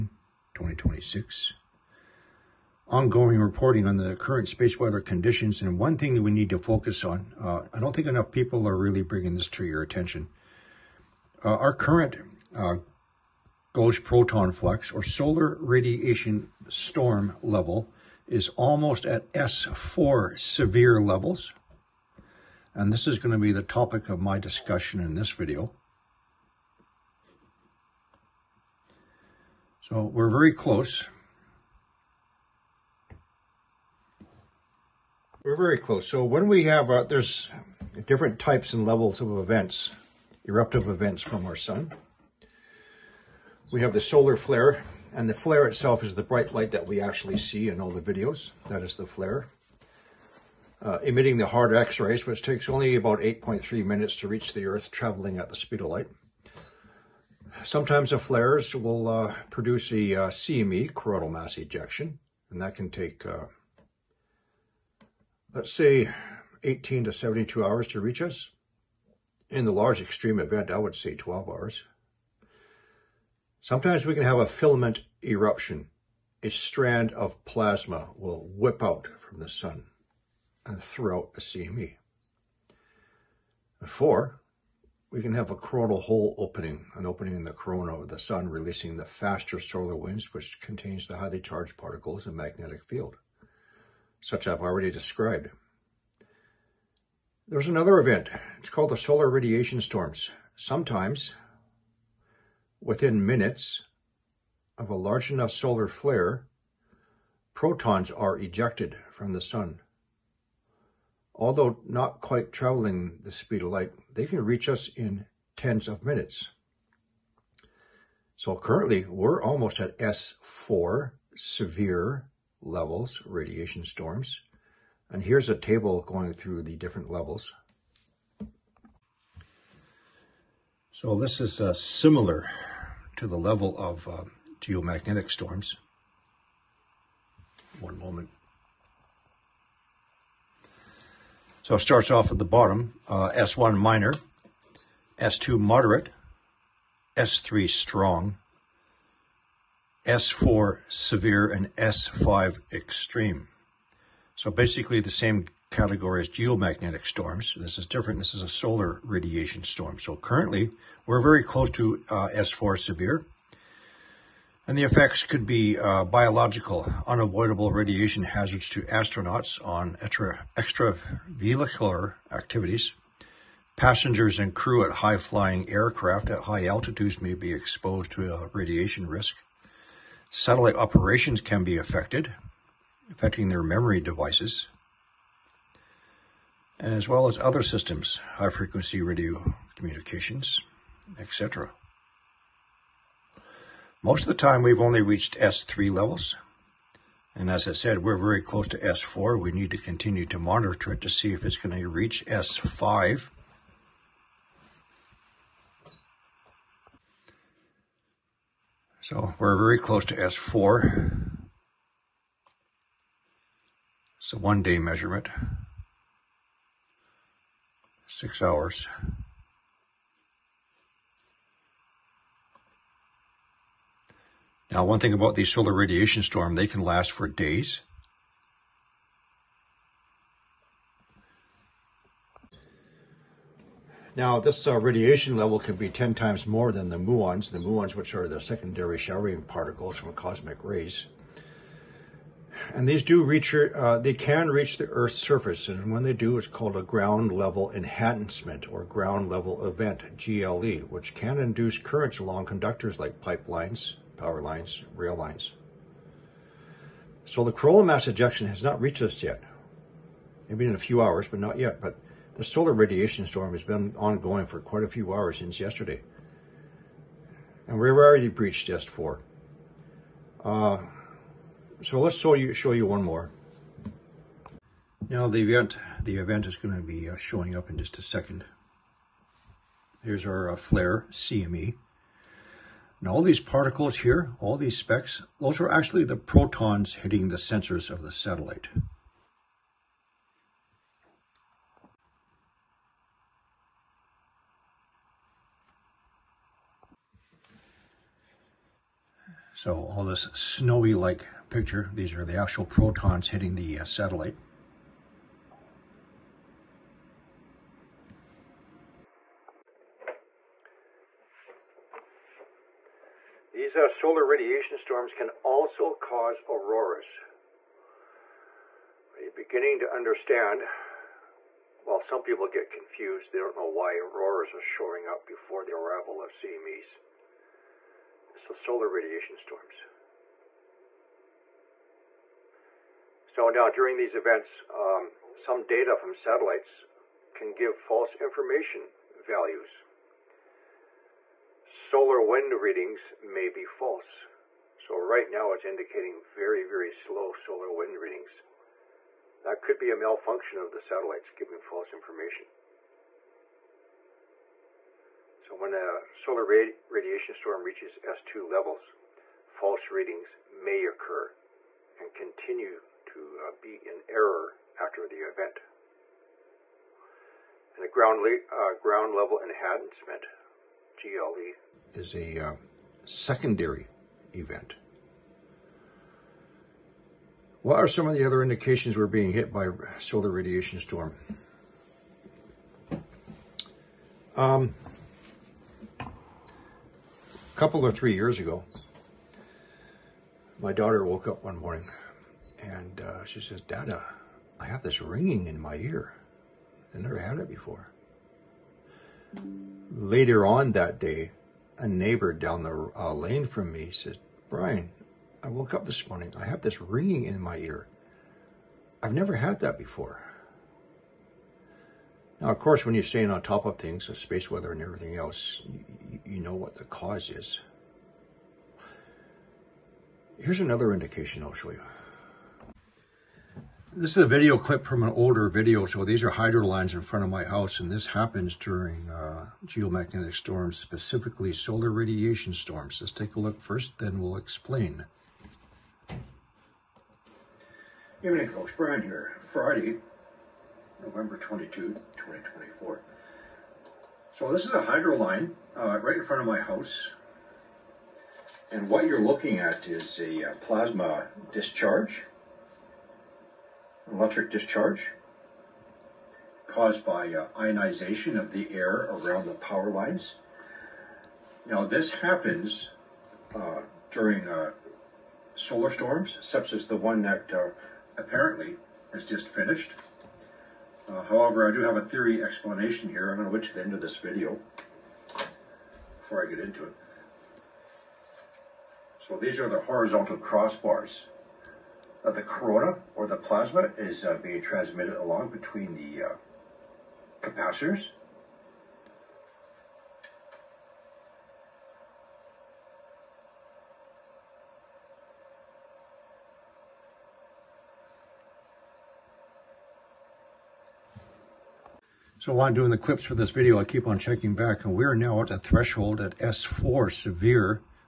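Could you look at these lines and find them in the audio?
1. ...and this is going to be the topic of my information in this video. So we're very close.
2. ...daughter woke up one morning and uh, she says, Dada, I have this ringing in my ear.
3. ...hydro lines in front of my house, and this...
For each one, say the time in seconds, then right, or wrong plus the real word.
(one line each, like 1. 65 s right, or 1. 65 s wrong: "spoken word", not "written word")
1. 22 s wrong: "discussion", not "information"
2. 390 s right
3. 426 s right.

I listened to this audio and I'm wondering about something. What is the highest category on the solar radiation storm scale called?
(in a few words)
S5 extreme.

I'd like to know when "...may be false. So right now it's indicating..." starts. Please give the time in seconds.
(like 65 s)
343 s.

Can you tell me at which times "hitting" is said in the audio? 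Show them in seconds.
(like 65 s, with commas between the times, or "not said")
286 s, 303 s.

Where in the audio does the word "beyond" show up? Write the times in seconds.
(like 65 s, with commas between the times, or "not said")
not said.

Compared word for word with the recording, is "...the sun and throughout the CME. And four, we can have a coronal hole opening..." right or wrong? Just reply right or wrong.
right.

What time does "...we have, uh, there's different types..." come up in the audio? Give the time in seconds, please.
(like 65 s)
36 s.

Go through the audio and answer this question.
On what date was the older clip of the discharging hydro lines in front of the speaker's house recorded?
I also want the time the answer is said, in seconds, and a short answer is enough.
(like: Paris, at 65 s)
November 22, 2024, at 441 s.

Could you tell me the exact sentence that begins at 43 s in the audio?
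We have the solar flare, and the flare itself is the bright light that we actually see in all the videos.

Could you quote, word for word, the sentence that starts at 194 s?
Most of the time, we've only reached S3 levels.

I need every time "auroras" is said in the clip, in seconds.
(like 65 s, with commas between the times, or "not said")
316 s, 323 s.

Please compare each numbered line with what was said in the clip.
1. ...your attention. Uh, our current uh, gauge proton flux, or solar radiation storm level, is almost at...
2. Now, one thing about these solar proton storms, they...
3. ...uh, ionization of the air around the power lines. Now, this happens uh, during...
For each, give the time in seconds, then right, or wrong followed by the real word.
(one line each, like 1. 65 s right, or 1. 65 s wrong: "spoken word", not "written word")
1. 9 s right
2. 224 s wrong: "radiation", not "proton"
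3. 457 s right.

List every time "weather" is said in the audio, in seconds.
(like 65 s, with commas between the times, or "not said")
4 s, 414 s.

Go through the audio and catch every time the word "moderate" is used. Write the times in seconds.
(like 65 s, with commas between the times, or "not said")
145 s.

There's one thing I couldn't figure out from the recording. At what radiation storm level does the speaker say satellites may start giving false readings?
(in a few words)
S2.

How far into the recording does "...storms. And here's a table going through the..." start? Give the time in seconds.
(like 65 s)
123 s.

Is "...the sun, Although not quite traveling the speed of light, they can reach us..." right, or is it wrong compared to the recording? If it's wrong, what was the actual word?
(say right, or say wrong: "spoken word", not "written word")
right.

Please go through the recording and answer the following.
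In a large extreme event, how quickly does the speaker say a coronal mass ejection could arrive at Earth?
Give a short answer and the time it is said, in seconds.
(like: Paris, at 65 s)
12 hours, at 71 s.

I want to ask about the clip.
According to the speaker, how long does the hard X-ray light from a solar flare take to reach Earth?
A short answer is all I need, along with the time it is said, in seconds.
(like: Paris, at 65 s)
8.3 minutes, at 53 s.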